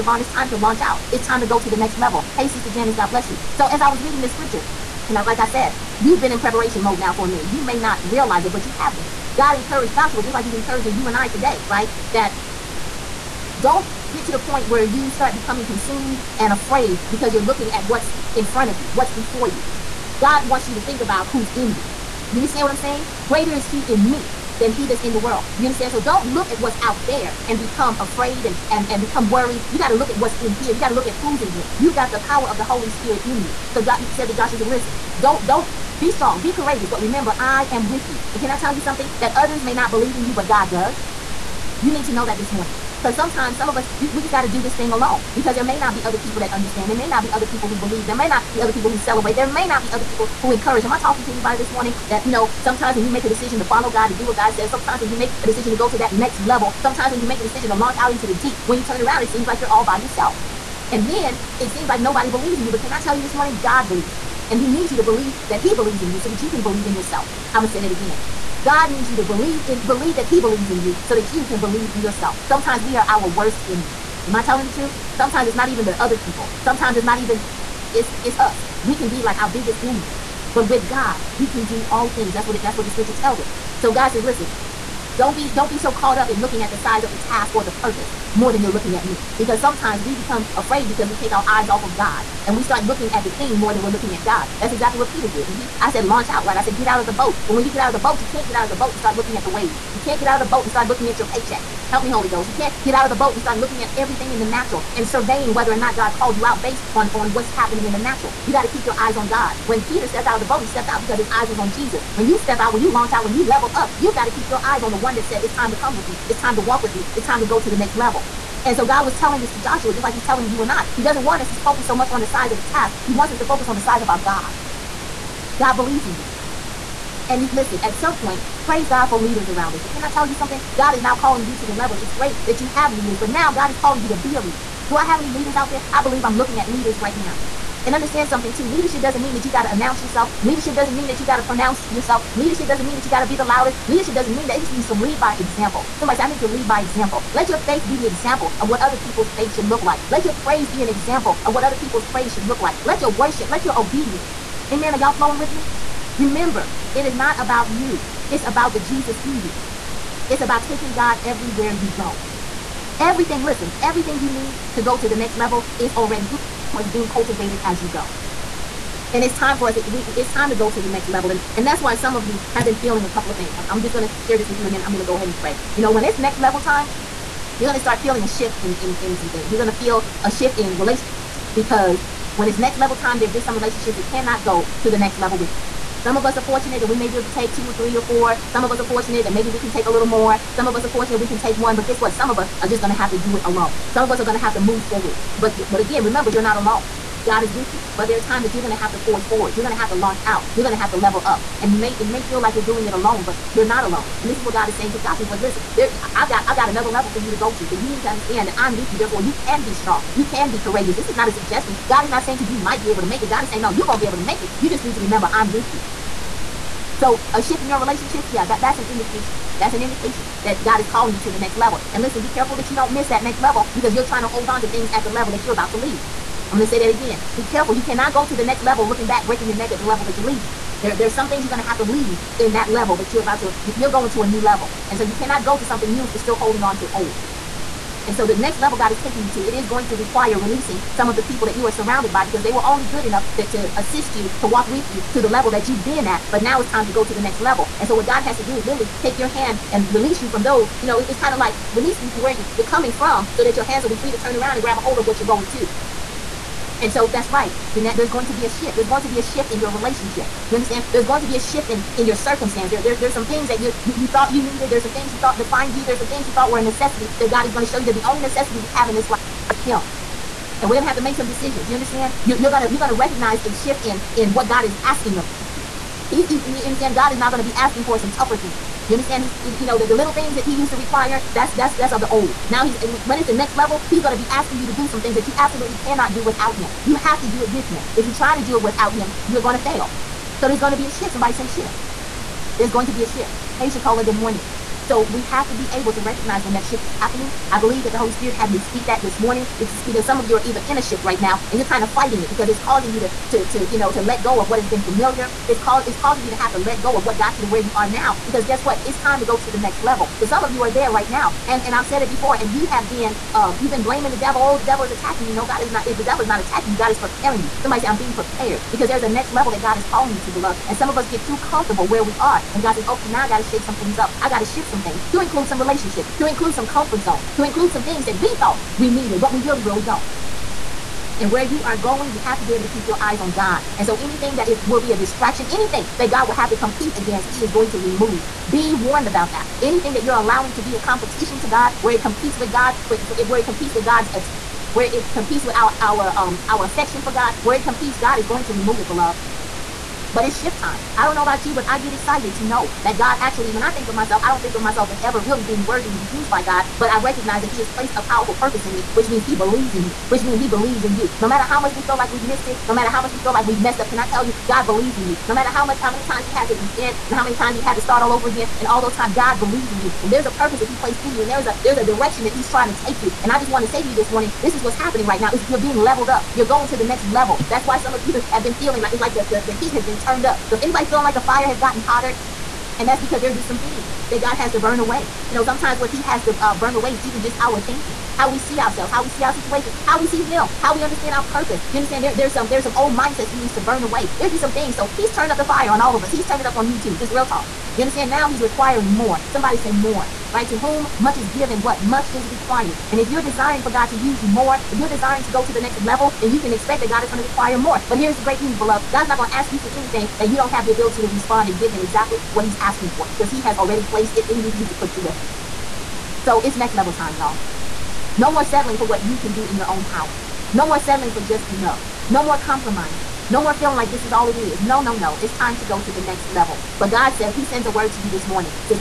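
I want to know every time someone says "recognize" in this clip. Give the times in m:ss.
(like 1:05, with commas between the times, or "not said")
4:32, 4:55, 5:57.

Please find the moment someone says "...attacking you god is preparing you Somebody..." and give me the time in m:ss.
5:16.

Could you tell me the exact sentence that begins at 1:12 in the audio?
Sometimes we are our worst enemy.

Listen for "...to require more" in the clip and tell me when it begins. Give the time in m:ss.
6:47.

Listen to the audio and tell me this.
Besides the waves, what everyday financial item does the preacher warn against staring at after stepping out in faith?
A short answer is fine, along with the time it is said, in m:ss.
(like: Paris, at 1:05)
Your paycheck, at 1:41.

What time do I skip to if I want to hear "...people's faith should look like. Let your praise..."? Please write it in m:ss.
2:28.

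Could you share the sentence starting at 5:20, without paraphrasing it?
And some of us get too comfortable where we are.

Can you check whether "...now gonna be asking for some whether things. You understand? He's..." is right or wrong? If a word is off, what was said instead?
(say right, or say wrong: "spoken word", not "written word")
wrong: "tougher", not "whether".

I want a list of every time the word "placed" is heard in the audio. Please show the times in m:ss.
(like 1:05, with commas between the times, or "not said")
5:57, 6:10, 6:53.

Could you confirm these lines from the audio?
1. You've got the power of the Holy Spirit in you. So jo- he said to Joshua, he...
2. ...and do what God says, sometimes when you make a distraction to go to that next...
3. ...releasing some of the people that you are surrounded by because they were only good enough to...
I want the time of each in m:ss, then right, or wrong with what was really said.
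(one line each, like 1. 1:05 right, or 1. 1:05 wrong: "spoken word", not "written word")
1. 0:31 right
2. 0:54 wrong: "decision", not "distraction"
3. 4:00 right.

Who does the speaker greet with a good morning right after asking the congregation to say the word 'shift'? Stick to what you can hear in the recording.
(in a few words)
Shakola.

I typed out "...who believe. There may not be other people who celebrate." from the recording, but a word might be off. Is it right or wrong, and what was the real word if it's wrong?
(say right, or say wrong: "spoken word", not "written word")
right.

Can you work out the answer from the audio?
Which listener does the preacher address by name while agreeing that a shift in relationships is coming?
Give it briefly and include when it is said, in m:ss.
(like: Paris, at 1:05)
Jeanette, at 4:17.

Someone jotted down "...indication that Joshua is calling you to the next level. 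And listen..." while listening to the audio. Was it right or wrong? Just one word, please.
wrong.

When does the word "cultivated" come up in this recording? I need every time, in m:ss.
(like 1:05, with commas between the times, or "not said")
2:47.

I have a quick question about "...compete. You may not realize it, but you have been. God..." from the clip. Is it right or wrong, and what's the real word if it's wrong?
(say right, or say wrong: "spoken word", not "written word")
wrong: "minute", not "compete".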